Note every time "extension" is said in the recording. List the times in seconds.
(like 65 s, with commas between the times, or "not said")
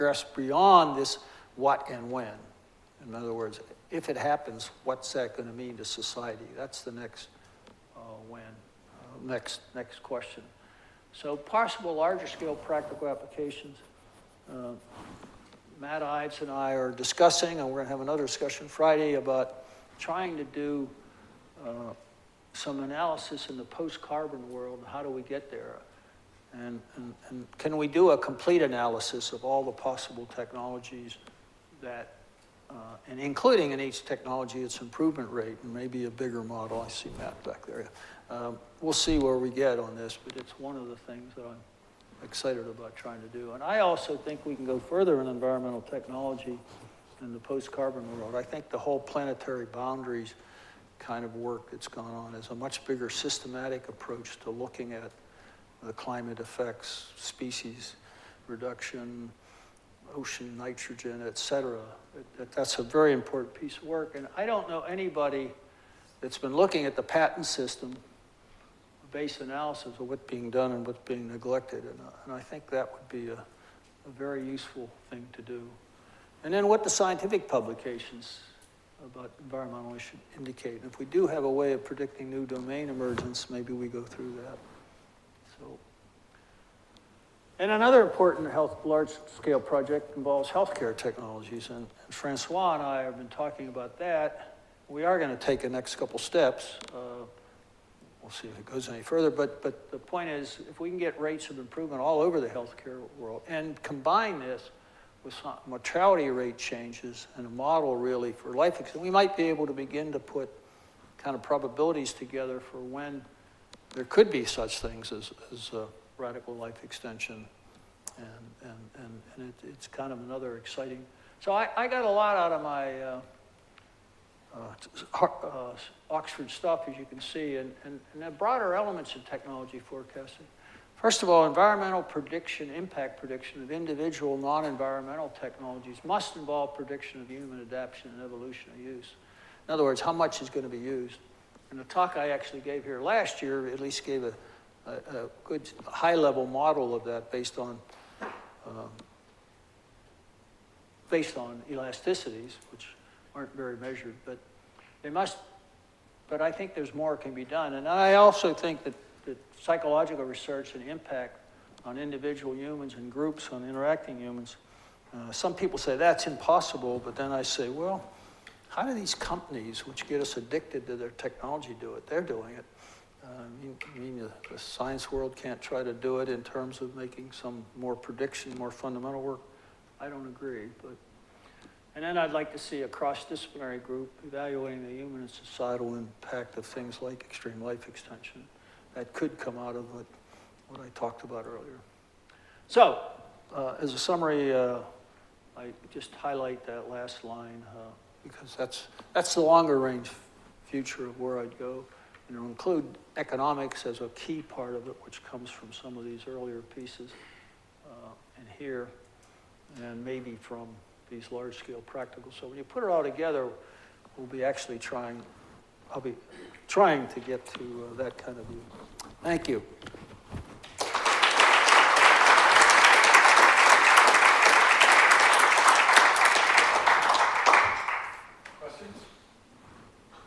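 116 s, 187 s.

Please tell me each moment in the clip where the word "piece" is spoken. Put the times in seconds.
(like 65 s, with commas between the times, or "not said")
63 s, 206 s.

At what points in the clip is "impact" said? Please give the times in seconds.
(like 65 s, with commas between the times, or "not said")
132 s, 160 s, 185 s.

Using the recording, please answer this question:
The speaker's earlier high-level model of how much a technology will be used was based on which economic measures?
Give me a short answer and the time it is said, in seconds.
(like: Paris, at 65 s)
elasticities, at 151 s.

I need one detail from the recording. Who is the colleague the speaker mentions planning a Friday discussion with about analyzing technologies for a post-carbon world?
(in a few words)
Matt Ives.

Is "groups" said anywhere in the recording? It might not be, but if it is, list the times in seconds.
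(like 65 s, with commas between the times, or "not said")
163 s, 183 s.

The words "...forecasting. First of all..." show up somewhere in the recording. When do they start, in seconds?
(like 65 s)
129 s.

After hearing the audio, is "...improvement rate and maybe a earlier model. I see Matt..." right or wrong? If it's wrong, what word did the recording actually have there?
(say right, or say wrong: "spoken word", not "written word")
wrong: "bigger", not "earlier".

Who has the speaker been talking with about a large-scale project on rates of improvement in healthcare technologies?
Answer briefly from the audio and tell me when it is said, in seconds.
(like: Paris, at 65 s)
Francois, at 92 s.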